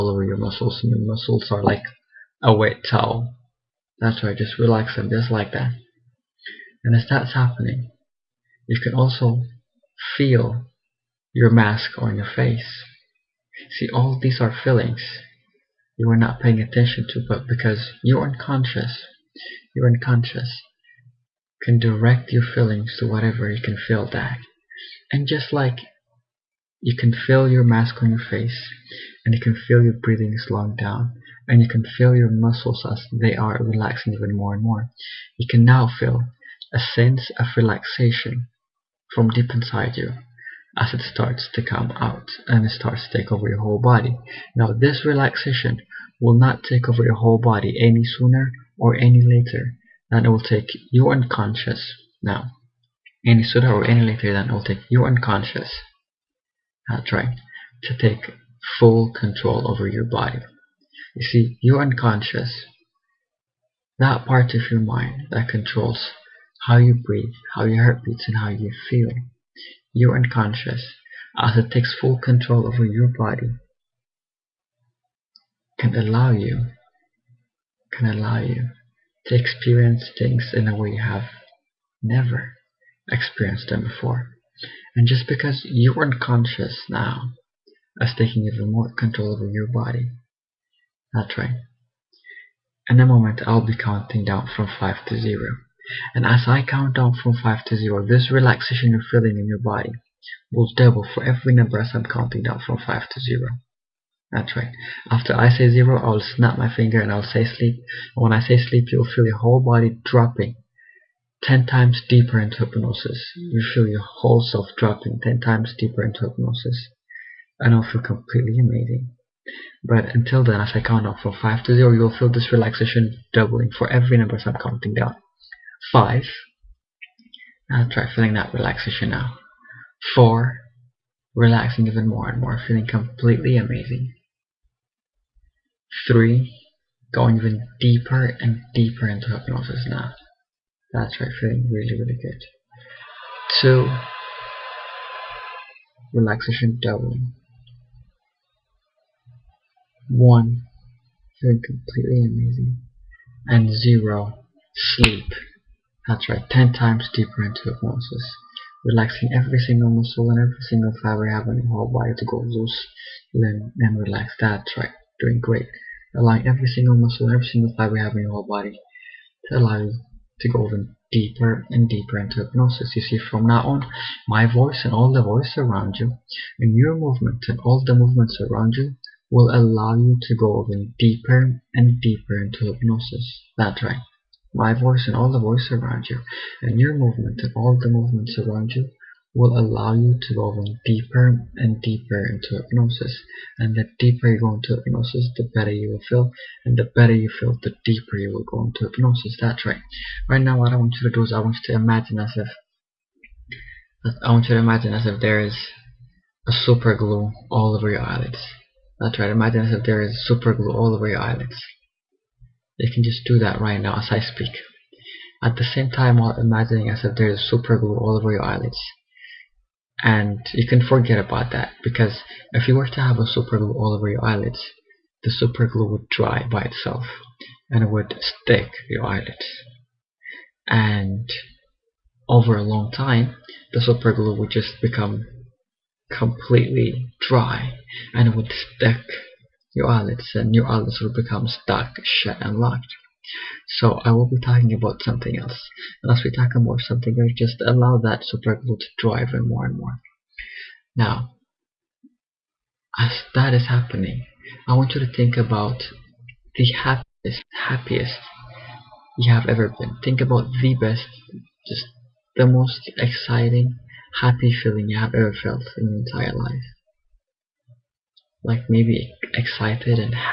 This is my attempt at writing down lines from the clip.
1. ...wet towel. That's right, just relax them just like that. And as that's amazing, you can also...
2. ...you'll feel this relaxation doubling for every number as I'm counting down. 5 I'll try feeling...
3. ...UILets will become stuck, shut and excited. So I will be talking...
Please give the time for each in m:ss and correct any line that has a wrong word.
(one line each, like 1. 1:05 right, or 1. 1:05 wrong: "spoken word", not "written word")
1. 0:02 wrong: "happening", not "amazing"
2. 2:01 right
3. 4:00 wrong: "locked", not "excited".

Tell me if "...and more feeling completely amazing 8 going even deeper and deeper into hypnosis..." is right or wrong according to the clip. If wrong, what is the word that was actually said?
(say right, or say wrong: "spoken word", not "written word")
wrong: "3", not "8".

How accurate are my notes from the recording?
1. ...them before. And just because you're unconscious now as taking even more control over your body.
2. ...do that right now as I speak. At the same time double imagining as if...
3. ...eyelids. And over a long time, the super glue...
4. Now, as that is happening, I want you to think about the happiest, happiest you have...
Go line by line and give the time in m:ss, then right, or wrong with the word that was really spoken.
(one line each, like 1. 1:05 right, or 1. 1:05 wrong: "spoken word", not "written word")
1. 1:23 right
2. 3:33 wrong: "while", not "double"
3. 3:49 right
4. 4:10 right.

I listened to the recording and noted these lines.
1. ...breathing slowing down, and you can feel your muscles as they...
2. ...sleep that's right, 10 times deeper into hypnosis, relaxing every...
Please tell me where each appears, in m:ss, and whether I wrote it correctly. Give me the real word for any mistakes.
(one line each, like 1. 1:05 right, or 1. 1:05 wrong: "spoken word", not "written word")
1. 0:29 right
2. 2:34 right.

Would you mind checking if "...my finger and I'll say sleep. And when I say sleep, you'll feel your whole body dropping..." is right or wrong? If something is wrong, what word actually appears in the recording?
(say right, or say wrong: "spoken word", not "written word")
right.